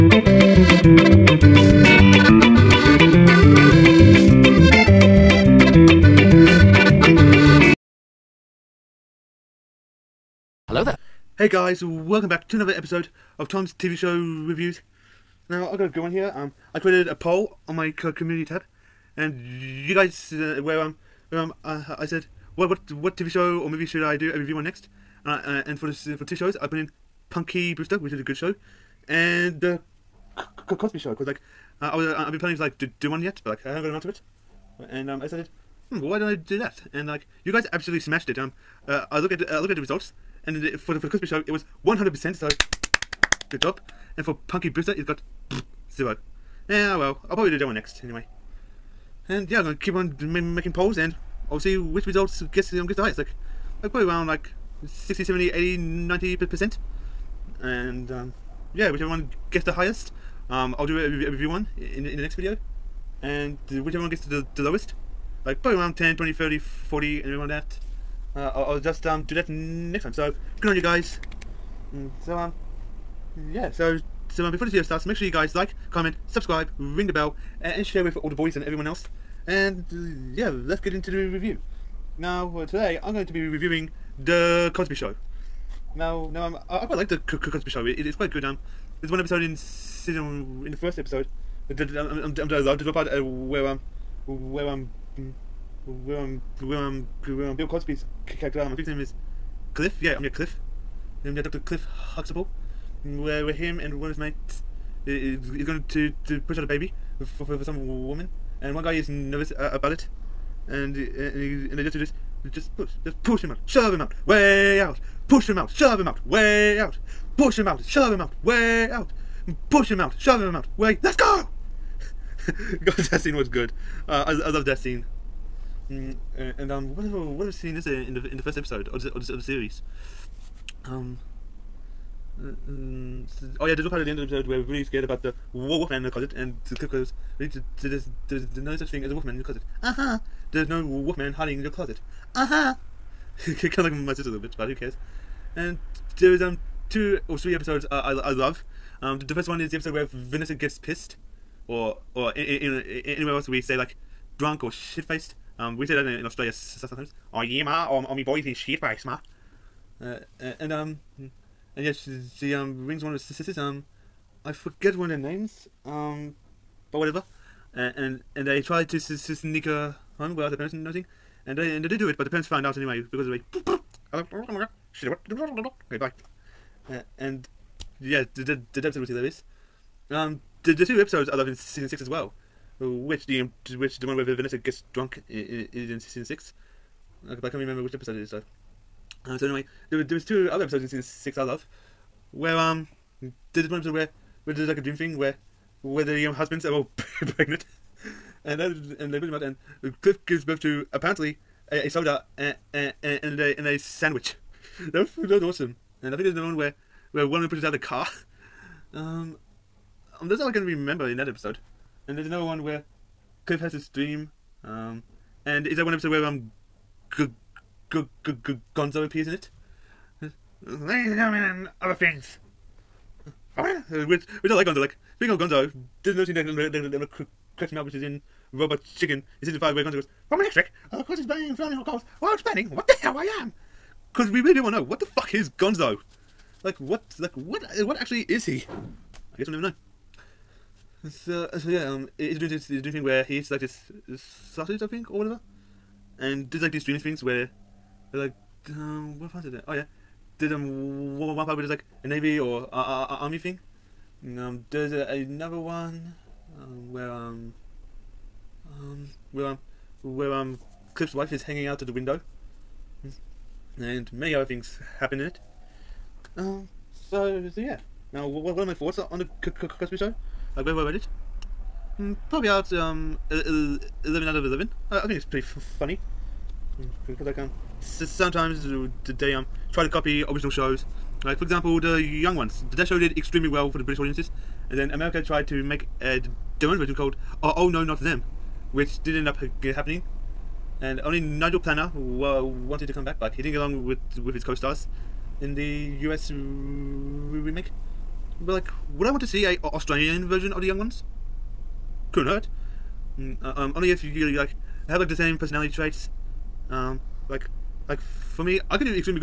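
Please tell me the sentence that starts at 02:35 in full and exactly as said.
Um, we say that in, in Australia sometimes.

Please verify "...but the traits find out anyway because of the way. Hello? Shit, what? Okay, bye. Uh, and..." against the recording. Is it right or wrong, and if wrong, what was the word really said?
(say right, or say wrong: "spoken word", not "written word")
wrong: "parents", not "traits".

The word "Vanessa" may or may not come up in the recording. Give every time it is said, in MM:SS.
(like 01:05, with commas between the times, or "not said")
02:30, 03:04.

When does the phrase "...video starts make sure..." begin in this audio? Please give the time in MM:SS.
01:14.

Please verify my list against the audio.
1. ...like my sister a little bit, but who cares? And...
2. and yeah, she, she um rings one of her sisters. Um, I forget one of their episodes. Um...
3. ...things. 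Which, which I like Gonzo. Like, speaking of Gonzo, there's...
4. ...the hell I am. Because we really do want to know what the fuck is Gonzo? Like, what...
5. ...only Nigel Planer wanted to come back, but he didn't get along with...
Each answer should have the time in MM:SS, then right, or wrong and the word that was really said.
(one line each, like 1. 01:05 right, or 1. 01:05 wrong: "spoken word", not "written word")
1. 02:23 right
2. 02:41 wrong: "names", not "episodes"
3. 03:41 right
4. 03:52 right
5. 04:50 right.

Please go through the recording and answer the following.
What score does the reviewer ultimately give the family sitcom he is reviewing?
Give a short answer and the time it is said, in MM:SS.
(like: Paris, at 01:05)
11 out of 11, at 04:33.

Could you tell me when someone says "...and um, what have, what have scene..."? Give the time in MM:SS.
02:06.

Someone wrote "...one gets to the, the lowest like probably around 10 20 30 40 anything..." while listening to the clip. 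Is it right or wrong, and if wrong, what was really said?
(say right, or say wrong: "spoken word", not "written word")
right.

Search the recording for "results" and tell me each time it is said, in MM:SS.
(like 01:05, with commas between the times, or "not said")
00:39, 00:52.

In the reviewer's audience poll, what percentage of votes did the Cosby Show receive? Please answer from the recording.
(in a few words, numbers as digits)
100 percent.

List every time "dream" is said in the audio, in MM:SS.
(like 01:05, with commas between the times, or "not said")
03:14, 03:33, 04:06.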